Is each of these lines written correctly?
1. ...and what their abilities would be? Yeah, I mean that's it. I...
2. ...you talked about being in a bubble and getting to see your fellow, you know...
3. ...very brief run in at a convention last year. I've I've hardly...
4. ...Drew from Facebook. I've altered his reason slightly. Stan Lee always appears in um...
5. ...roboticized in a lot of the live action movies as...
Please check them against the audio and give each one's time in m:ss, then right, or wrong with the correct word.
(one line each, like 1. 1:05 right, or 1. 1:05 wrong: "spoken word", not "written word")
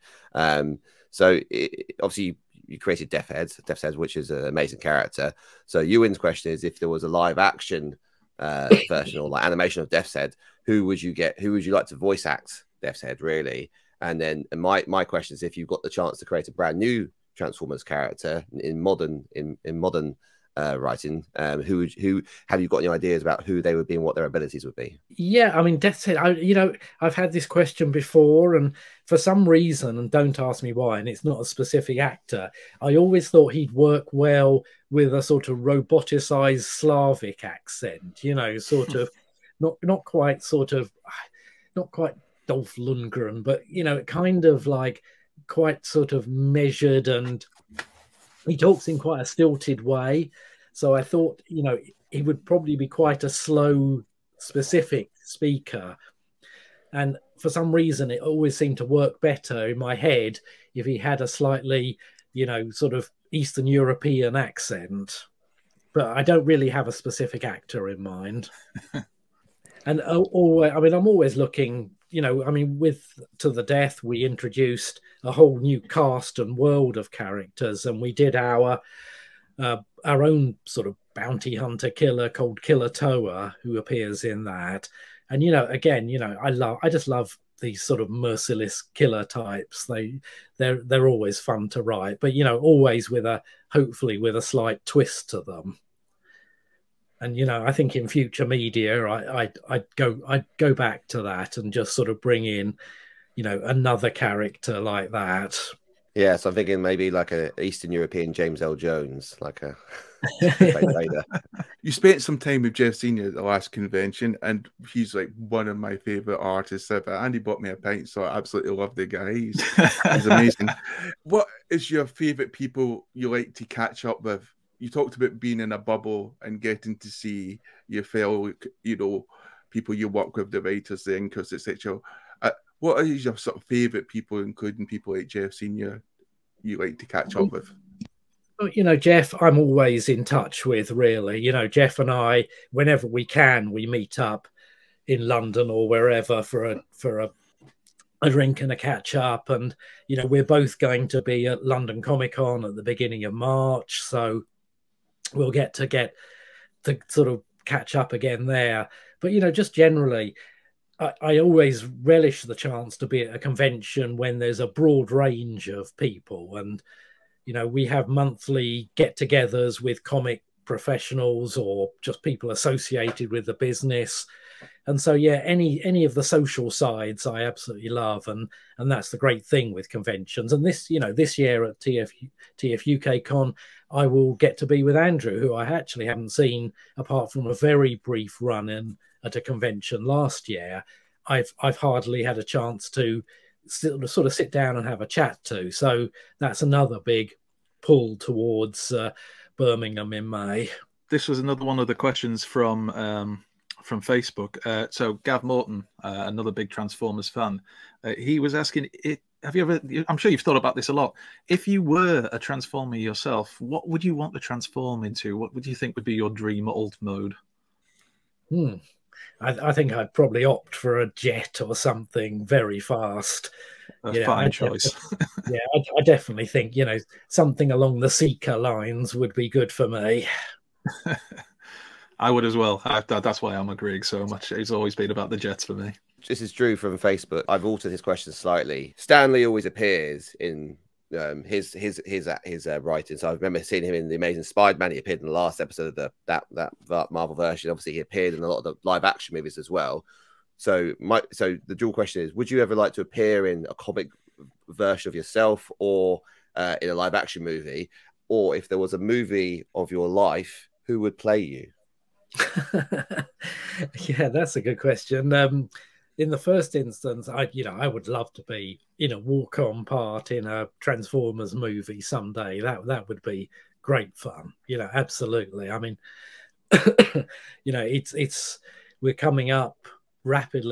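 1. 0:23 right
2. 2:04 right
3. 3:07 right
4. 3:56 wrong: "question", not "reason"
5. 4:07 wrong: "appeared", not "roboticized".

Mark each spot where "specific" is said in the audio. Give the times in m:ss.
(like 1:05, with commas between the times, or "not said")
0:31, 0:54, 1:06.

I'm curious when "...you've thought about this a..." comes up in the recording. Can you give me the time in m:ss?
3:30.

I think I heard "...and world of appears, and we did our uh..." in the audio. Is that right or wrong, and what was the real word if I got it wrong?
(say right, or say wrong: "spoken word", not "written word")
wrong: "characters", not "appears".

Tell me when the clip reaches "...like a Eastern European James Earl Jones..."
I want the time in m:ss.
1:47.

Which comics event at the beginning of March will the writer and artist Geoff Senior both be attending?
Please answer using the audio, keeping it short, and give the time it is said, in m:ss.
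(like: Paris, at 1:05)
London Comic Con, at 2:31.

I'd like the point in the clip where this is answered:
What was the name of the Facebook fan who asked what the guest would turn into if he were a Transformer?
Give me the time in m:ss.
3:25.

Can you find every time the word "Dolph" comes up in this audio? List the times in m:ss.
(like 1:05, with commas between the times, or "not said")
0:42.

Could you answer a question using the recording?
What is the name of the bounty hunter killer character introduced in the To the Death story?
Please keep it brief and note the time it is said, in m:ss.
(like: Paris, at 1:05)
Killer Toa, at 1:22.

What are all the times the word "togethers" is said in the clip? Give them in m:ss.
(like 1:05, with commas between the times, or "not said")
2:48.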